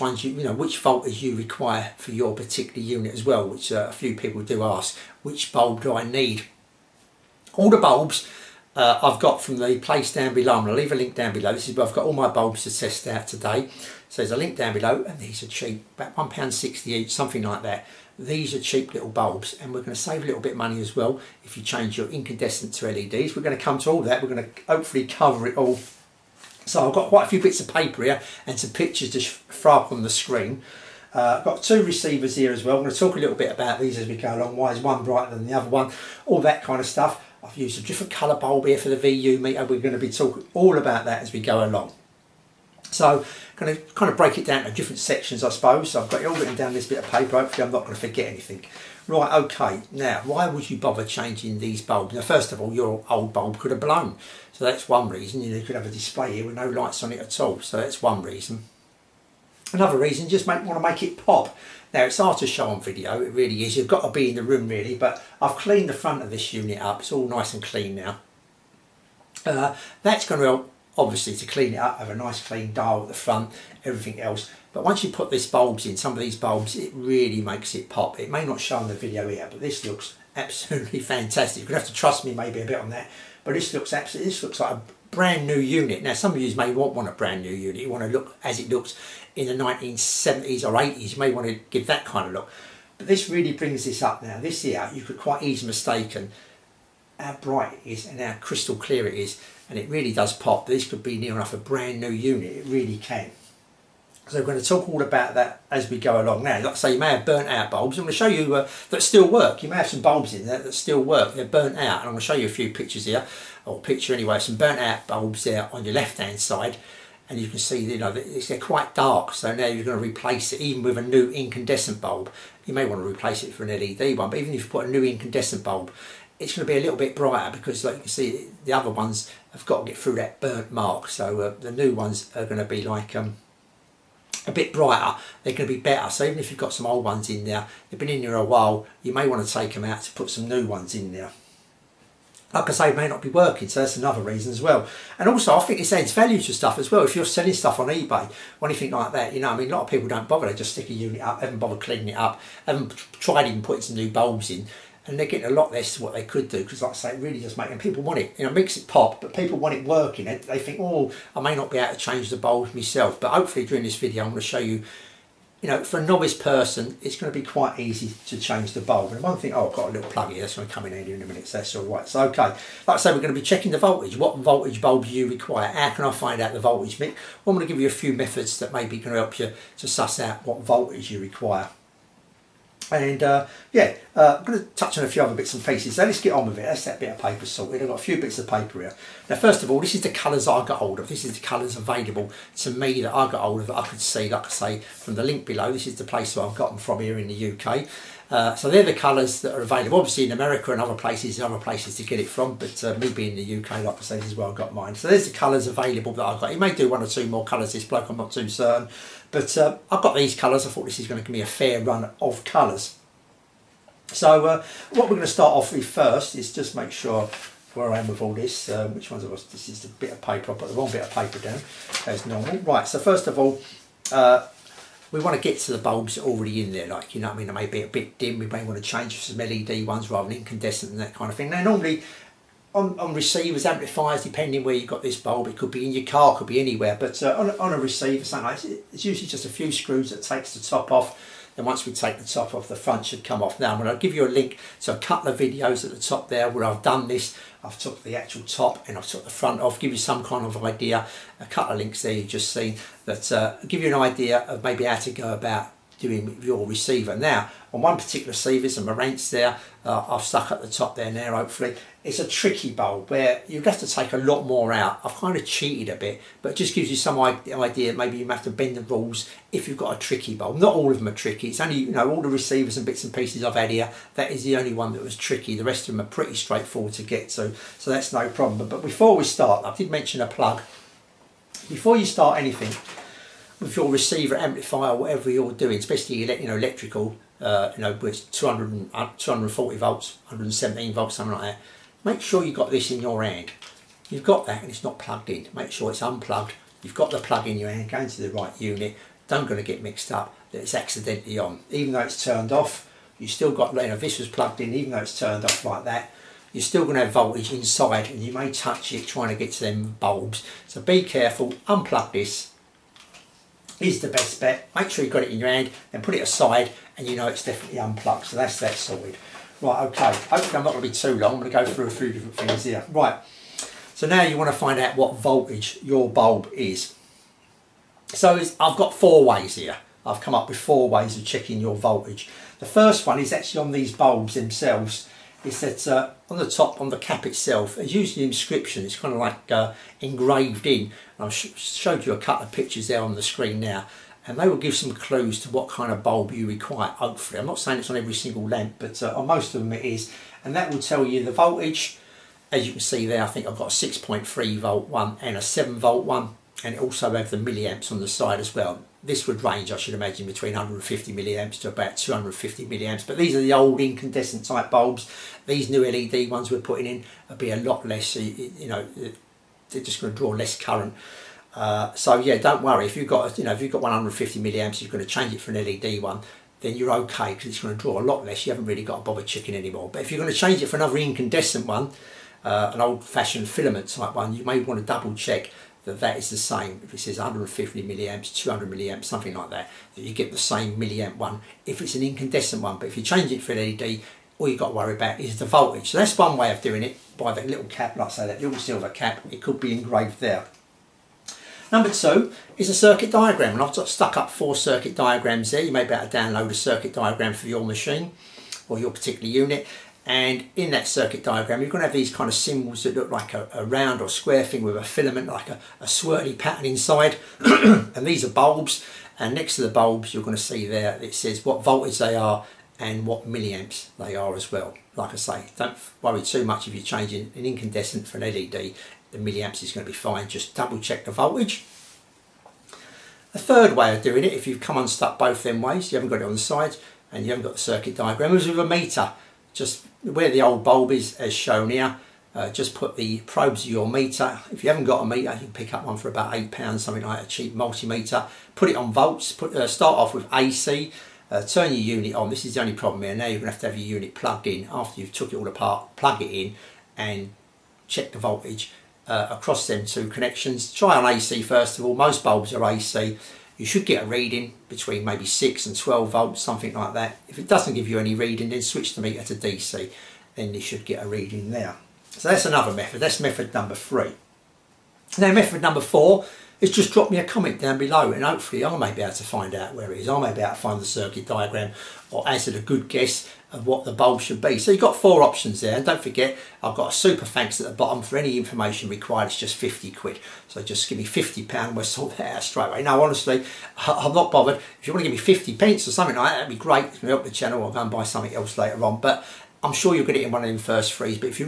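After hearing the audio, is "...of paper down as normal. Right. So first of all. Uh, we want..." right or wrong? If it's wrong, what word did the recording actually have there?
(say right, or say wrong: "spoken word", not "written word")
right.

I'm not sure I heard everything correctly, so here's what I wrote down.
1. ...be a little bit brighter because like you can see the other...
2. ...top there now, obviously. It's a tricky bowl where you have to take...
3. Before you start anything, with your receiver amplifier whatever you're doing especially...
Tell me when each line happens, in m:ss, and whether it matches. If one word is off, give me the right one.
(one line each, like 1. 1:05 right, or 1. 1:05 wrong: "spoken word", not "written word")
1. 2:06 right
2. 4:20 wrong: "hopefully", not "obviously"
3. 4:41 right.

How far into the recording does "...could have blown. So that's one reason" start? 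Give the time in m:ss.
0:53.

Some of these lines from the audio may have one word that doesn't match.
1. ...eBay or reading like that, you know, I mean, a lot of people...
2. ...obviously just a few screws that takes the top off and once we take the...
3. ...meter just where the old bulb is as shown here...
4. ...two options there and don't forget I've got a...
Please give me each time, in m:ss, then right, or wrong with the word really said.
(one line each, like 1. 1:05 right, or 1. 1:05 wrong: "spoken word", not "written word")
1. 2:27 wrong: "anything", not "reading"
2. 3:59 wrong: "usually", not "obviously"
3. 7:18 right
4. 8:04 wrong: "four", not "two".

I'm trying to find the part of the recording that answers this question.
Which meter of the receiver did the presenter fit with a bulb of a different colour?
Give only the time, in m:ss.
0:38.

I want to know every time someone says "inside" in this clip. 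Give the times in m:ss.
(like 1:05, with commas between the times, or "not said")
5:07, 6:56.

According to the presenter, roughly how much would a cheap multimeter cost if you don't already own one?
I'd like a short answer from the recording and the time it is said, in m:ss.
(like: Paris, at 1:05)
8 pounds, at 7:26.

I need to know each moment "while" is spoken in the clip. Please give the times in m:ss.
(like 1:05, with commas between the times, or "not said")
2:18.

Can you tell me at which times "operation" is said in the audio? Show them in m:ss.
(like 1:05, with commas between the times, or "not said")
not said.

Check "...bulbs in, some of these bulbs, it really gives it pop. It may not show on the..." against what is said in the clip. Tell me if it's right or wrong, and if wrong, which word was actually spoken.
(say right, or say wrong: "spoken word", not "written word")
wrong: "makes", not "gives".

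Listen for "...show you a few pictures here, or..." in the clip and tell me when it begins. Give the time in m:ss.
1:52.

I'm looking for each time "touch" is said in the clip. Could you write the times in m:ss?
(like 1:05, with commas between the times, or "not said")
3:04, 5:08.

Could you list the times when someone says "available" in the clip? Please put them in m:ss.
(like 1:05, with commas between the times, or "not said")
3:11, 3:19, 3:25.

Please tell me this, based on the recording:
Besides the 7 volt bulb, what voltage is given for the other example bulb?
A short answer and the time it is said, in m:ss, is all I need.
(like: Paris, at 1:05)
6.3 volts, at 5:53.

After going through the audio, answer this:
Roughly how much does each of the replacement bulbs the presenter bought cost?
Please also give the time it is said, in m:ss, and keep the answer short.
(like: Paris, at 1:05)
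£1.60, at 0:16.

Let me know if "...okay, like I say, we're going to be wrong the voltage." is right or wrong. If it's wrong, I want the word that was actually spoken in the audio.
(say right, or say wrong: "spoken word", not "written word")
wrong: "checking", not "wrong".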